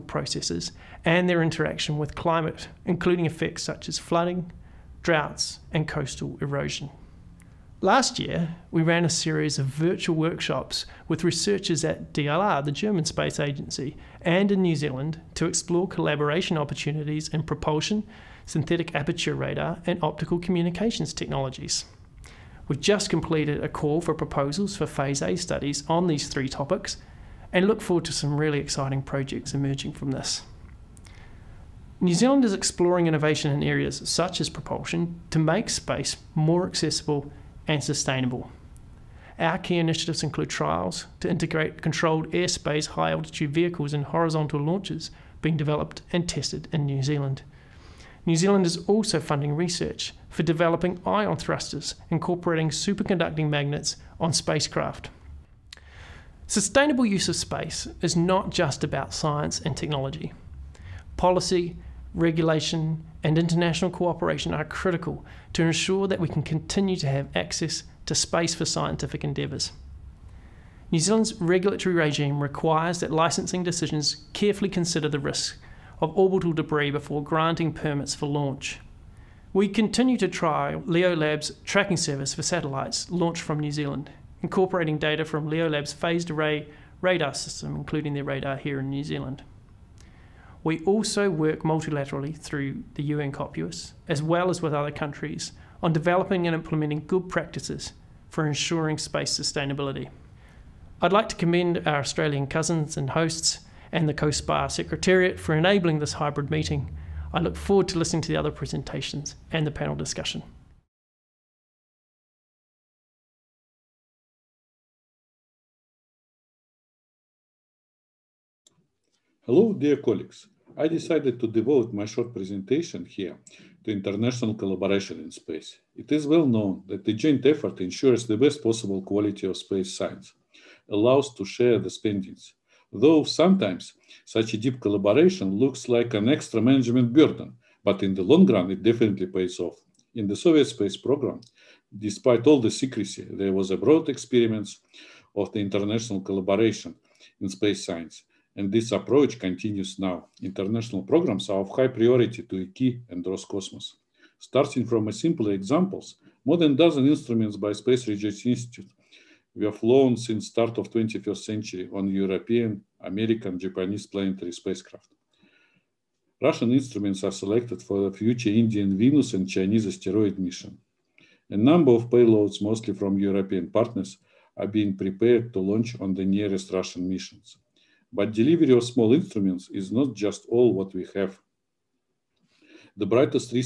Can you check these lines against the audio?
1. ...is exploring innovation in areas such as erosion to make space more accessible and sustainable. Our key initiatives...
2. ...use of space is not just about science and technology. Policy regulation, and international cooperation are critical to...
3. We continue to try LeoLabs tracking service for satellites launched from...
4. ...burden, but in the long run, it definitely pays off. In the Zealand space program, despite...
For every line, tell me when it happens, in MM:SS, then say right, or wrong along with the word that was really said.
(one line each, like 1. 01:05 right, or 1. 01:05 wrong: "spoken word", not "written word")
1. 00:32 wrong: "propulsion", not "erosion"
2. 00:57 right
3. 01:19 right
4. 02:17 wrong: "Soviet", not "Zealand".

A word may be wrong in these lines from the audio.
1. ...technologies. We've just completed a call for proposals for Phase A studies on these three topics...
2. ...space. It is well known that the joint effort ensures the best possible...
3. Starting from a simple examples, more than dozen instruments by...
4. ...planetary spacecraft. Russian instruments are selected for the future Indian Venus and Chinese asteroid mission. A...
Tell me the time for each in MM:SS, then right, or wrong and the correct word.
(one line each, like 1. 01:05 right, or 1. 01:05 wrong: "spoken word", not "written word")
1. 00:21 right
2. 02:05 right
3. 02:34 right
4. 02:44 right.